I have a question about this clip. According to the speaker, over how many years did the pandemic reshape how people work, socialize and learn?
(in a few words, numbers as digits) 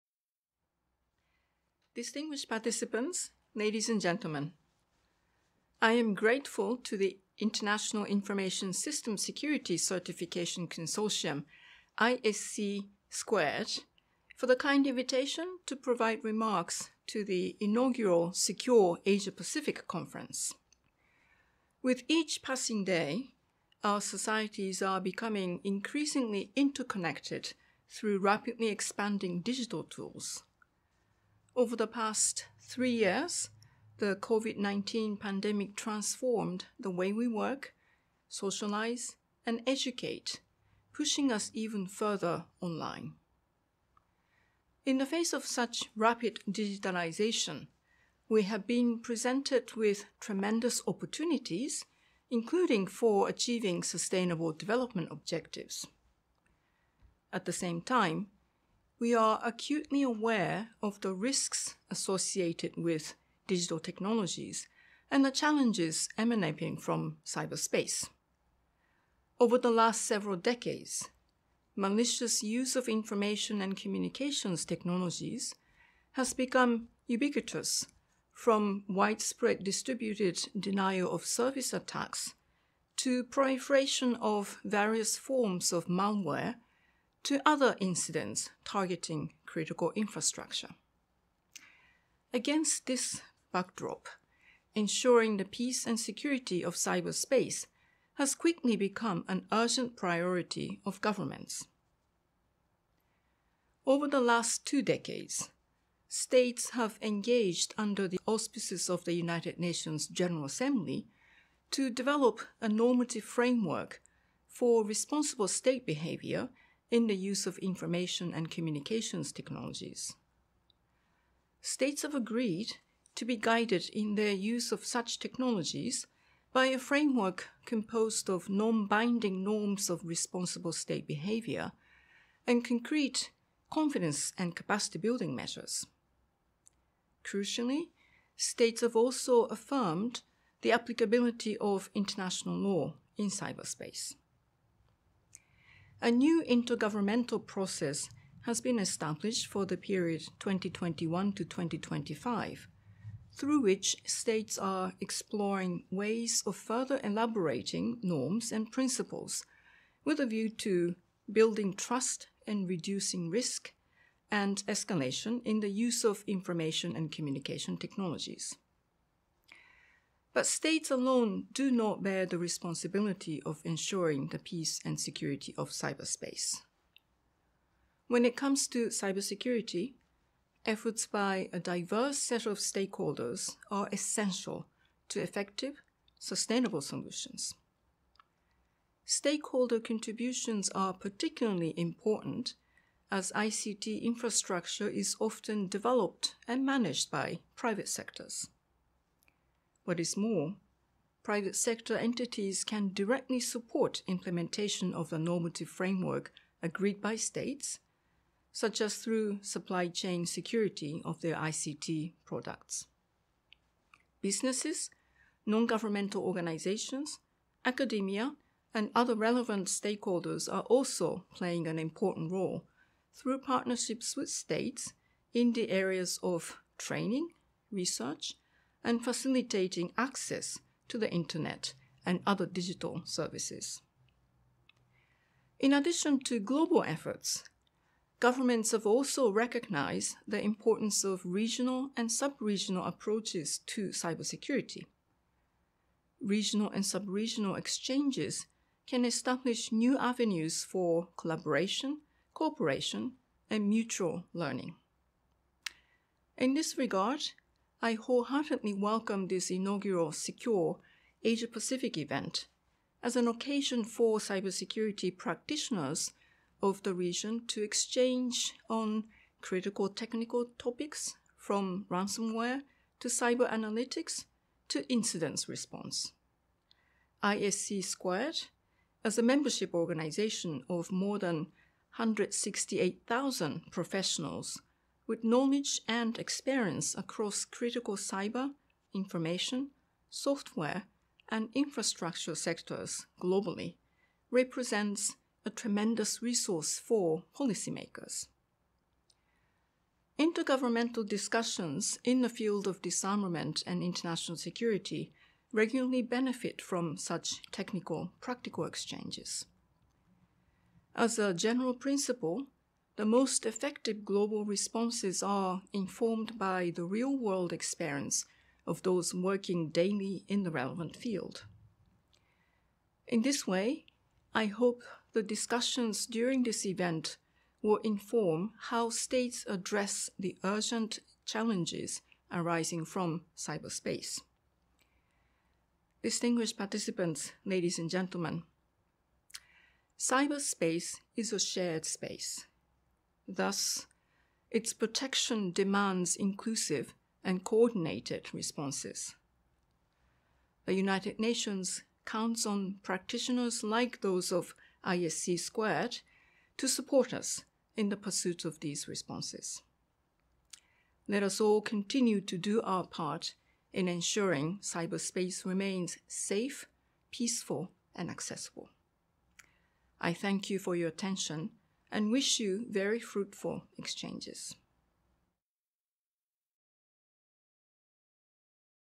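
3.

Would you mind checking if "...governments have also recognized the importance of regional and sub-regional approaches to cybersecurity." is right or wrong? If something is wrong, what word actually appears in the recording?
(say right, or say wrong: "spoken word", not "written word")
right.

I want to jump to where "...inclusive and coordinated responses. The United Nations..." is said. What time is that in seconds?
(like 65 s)
346 s.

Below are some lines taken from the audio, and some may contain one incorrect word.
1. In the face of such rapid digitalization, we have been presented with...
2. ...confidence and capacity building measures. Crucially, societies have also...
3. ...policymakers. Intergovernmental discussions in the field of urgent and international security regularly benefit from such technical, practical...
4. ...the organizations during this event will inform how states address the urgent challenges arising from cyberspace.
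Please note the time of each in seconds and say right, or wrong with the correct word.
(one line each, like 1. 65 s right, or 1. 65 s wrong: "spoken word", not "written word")
1. 44 s right
2. 133 s wrong: "states", not "societies"
3. 297 s wrong: "disarmament", not "urgent"
4. 325 s wrong: "discussions", not "organizations".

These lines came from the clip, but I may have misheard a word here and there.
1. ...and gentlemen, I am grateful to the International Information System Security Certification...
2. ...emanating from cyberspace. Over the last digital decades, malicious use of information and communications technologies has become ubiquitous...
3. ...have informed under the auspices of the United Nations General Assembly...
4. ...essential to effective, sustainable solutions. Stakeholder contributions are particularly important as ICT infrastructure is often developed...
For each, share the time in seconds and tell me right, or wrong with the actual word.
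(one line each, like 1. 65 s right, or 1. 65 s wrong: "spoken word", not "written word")
1. 3 s right
2. 66 s wrong: "several", not "digital"
3. 106 s wrong: "engaged", not "informed"
4. 183 s right.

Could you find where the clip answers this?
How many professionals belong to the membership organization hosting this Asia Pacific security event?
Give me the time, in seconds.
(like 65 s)
281 s.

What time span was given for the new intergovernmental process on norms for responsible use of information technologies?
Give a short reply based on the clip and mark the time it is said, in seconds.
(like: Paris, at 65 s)
2021 to 2025, at 150 s.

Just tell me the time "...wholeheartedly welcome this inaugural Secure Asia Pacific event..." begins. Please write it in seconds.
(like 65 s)
257 s.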